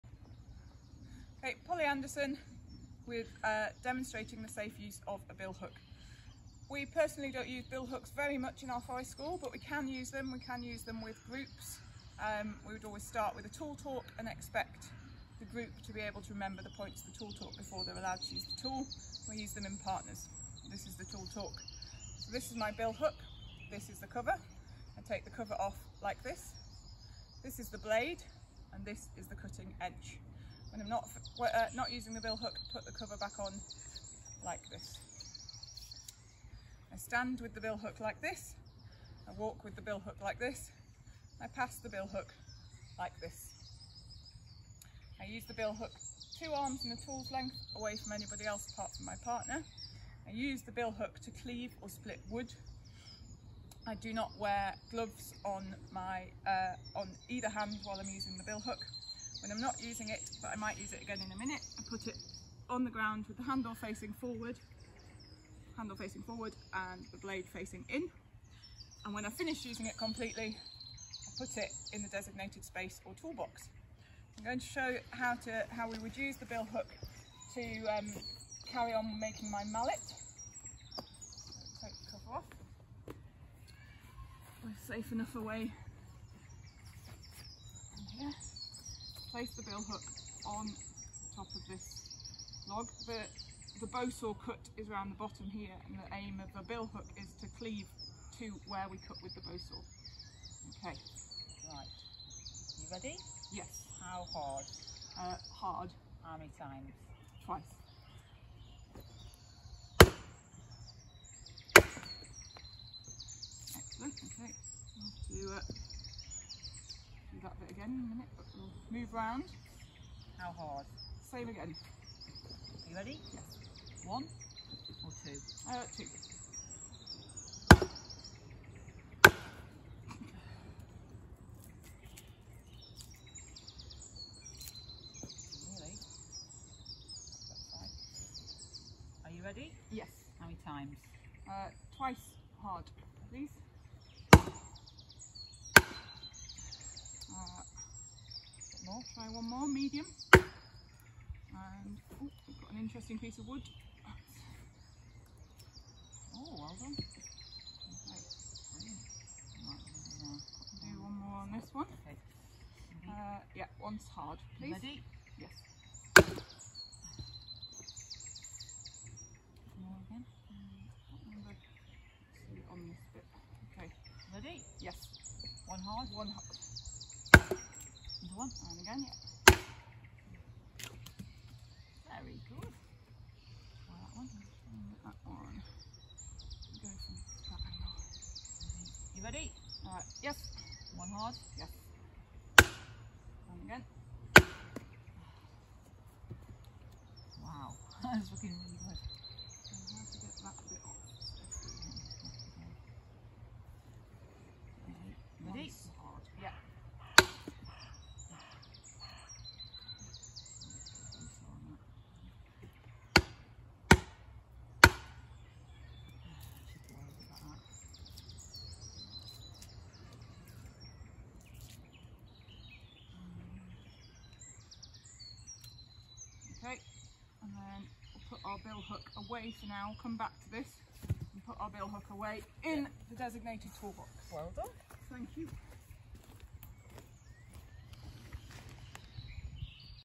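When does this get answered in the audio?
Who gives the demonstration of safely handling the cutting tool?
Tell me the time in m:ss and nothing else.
0:01.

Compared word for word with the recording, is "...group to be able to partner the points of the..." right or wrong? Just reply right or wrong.
wrong.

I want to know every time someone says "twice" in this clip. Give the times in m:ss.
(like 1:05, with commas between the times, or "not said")
1:47, 2:21.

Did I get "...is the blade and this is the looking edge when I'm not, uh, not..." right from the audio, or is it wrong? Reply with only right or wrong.
wrong.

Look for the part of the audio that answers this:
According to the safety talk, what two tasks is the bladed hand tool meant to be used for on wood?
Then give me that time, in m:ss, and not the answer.
0:51.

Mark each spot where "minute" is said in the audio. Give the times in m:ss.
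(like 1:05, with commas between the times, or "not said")
1:01, 1:58.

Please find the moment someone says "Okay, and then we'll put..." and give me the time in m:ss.
3:46.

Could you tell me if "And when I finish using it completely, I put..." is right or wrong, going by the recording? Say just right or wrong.
right.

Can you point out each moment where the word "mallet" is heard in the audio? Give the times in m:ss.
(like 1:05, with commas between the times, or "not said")
1:19.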